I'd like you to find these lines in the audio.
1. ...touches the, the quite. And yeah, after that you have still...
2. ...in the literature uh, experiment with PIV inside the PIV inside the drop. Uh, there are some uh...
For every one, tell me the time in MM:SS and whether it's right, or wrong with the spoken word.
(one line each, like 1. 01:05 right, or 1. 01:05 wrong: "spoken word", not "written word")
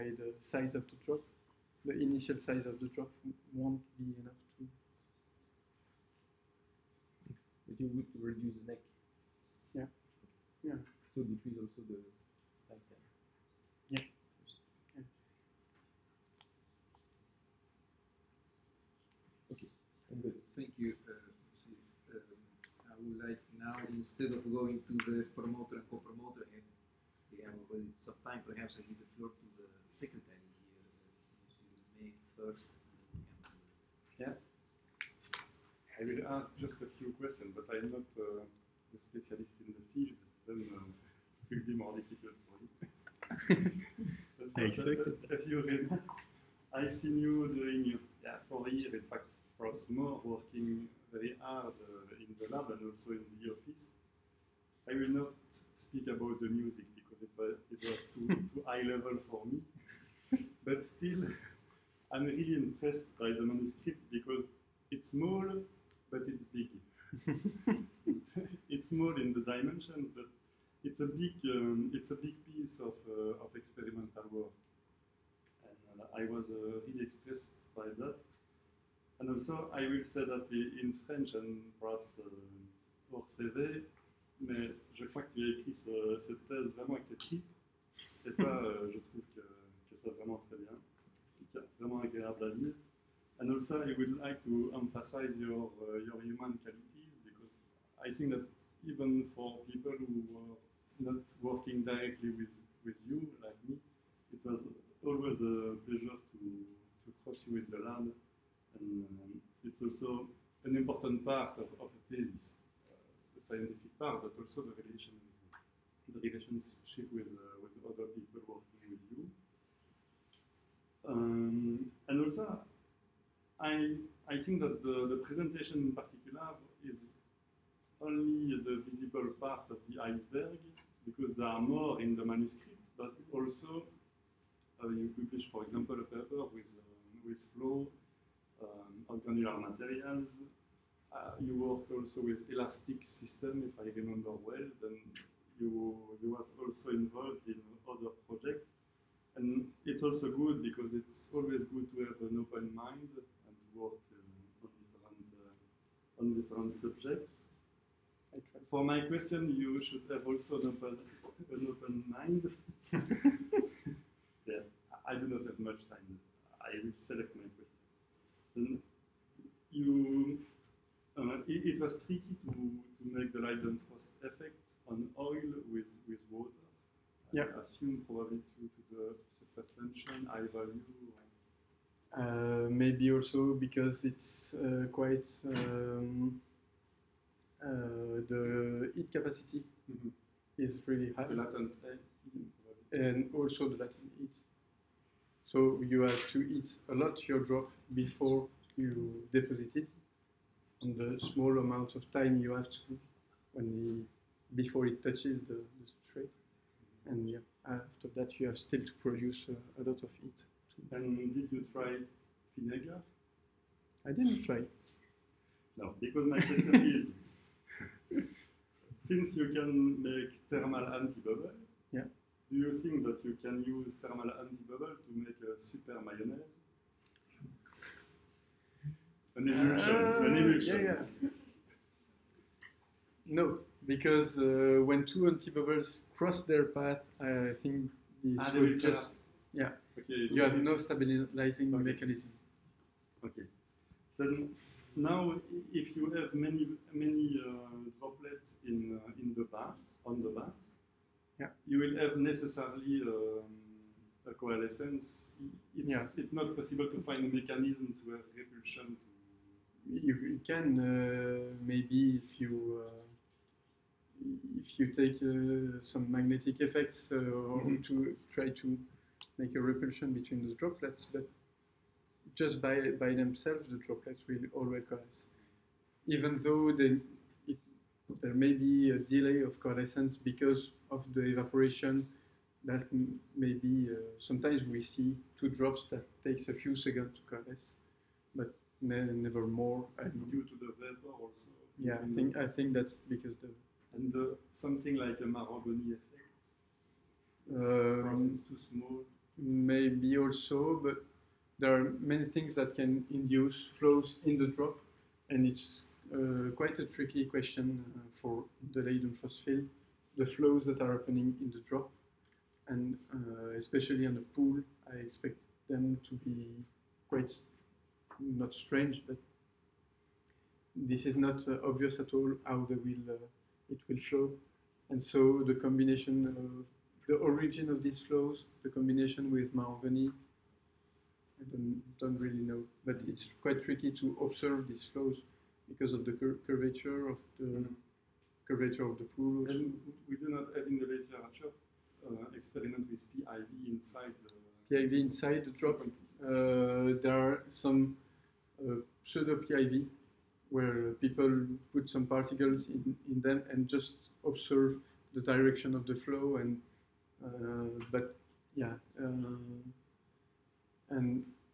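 1. 03:25 wrong: "substrate", not "quite"
2. 05:40 right.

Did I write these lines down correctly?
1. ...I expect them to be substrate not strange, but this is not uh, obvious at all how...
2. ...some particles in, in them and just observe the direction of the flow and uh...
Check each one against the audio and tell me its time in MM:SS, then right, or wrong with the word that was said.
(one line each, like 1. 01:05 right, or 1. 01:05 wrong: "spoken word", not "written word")
1. 05:14 wrong: "quite", not "substrate"
2. 05:51 right.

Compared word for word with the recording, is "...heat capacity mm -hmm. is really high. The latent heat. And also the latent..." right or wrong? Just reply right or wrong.
right.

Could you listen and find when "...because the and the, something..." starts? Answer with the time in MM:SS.
04:53.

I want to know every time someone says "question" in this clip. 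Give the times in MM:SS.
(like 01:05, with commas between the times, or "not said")
00:37, 02:39, 03:36, 05:07.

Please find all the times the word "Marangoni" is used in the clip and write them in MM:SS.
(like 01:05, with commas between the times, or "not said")
04:55, 05:29.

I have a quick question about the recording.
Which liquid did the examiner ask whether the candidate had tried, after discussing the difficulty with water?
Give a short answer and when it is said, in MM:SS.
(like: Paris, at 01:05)
vinegar, at 03:32.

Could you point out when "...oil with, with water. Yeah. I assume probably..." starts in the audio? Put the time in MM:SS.
02:55.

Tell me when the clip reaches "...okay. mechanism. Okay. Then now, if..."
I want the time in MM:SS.
04:01.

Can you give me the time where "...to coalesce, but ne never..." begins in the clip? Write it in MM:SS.
04:47.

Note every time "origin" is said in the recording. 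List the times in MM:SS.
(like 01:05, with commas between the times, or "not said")
05:27.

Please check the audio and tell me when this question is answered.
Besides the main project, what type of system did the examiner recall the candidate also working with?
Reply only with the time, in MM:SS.
02:22.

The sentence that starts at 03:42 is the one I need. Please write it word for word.
Do you think that you can use thermal anti-bubble to make a super mayonnaise?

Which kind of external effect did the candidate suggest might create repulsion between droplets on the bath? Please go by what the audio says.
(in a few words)
magnetic effects.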